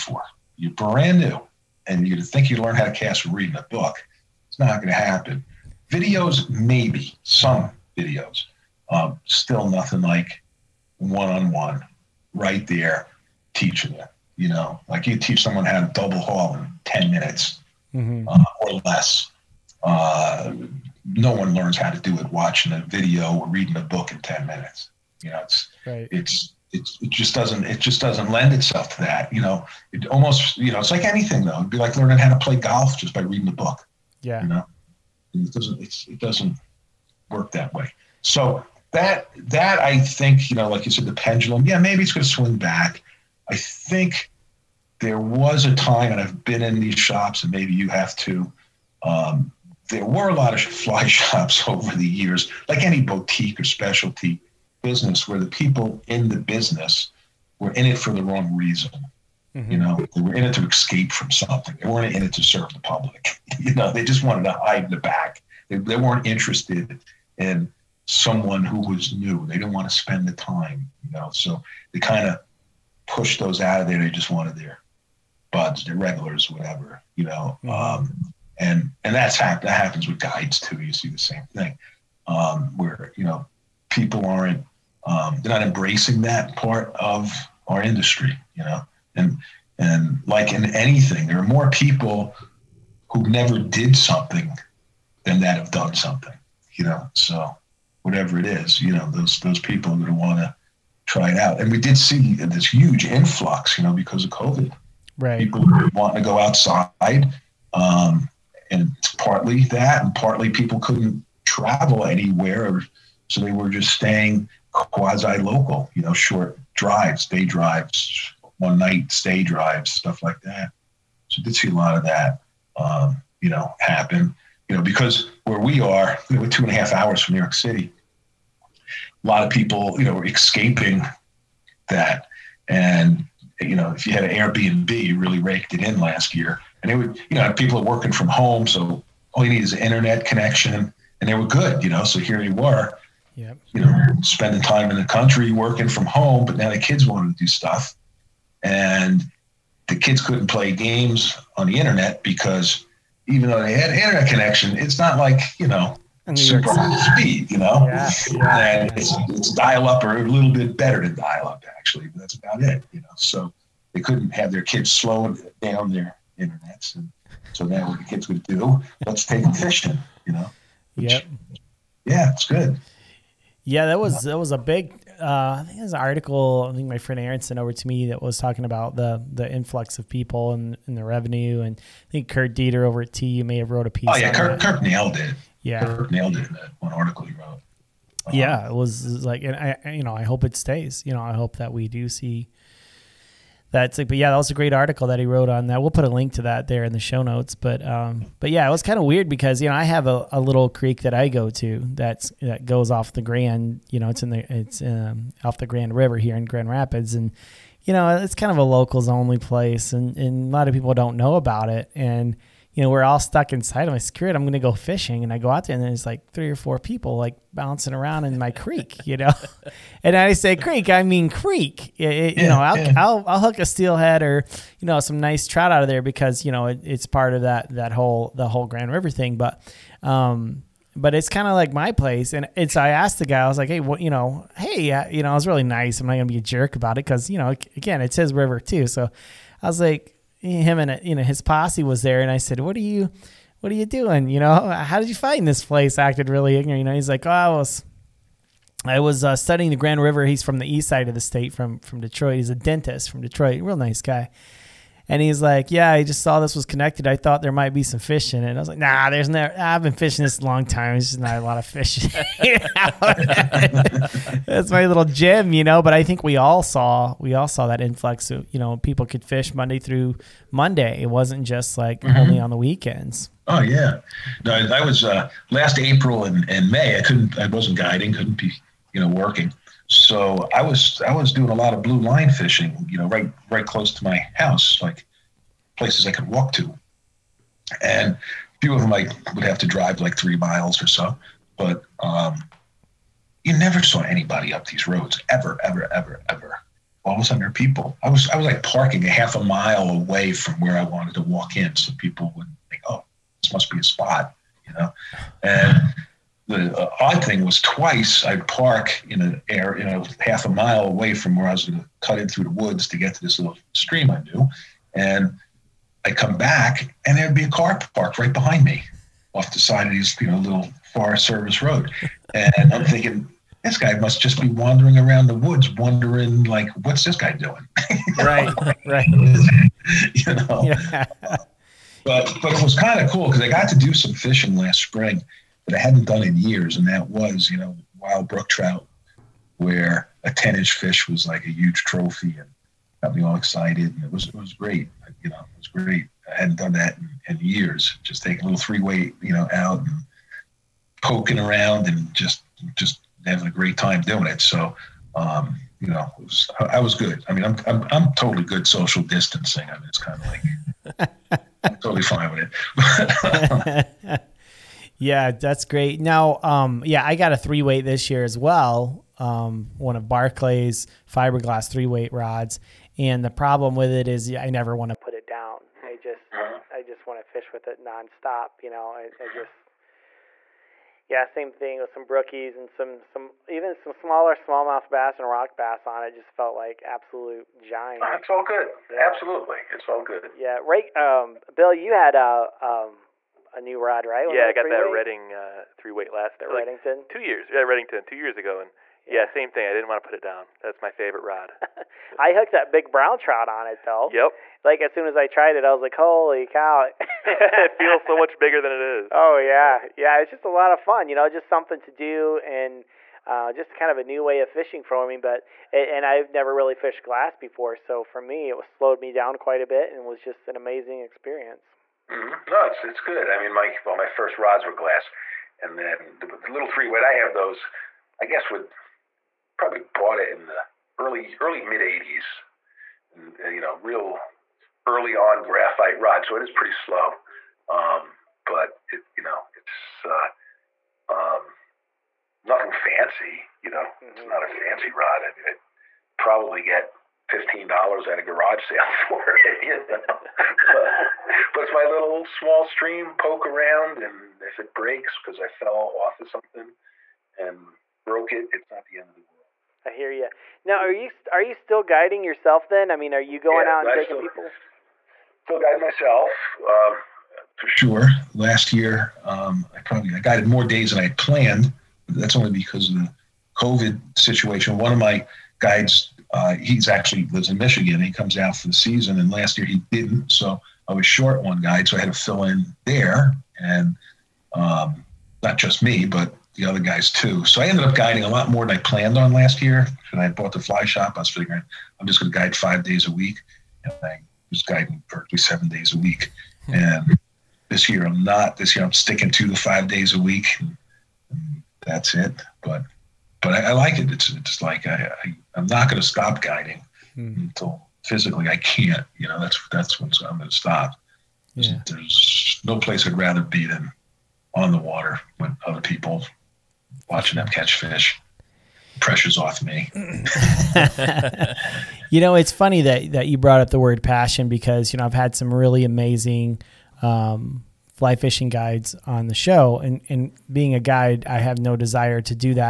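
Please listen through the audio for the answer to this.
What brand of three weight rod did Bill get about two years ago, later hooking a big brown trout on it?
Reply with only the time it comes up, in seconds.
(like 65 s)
397 s.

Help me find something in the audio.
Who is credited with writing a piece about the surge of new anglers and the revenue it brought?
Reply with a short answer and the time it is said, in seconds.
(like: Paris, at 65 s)
Kirk Deeter, at 182 s.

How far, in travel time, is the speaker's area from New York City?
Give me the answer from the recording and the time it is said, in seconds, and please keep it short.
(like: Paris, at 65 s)
two and a half hours, at 126 s.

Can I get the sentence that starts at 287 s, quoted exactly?
And a few of them I would have to drive like three miles or so.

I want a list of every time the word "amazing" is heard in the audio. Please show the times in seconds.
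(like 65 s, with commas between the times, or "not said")
420 s, 525 s.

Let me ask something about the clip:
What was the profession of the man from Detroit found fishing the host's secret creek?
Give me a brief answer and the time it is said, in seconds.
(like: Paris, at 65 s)
dentist, at 252 s.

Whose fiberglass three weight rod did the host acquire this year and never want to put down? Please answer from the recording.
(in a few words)
Barclay.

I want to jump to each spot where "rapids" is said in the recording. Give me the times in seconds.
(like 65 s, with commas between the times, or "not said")
206 s.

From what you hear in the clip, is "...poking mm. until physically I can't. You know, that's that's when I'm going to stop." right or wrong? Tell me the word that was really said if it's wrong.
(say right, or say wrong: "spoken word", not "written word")
wrong: "guiding", not "poking".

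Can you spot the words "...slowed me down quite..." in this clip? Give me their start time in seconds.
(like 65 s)
418 s.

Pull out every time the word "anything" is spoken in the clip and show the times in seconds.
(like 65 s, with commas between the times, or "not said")
31 s, 90 s.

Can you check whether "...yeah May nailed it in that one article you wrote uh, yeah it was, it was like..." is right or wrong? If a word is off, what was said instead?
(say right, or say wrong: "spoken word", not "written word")
wrong: "Kirk", not "May".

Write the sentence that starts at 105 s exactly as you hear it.
people who want to go outside.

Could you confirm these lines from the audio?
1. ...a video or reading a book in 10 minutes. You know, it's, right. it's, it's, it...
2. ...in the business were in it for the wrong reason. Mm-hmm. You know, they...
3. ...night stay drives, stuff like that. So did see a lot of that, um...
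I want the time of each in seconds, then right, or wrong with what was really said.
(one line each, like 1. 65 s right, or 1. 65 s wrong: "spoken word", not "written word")
1. 22 s right
2. 56 s right
3. 118 s right.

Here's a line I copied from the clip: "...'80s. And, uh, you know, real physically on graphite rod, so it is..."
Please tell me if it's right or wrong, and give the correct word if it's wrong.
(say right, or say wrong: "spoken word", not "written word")
wrong: "early", not "physically".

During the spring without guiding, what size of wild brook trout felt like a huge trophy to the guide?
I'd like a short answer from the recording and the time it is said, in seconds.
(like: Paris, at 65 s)
10 inch, at 340 s.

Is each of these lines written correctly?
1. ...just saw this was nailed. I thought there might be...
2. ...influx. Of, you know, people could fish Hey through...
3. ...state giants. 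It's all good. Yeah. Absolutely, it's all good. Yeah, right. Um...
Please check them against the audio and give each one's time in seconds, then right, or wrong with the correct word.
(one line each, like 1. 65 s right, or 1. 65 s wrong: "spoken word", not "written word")
1. 256 s wrong: "connected", not "nailed"
2. 267 s wrong: "Monday", not "Hey"
3. 386 s wrong: "absolute", not "state".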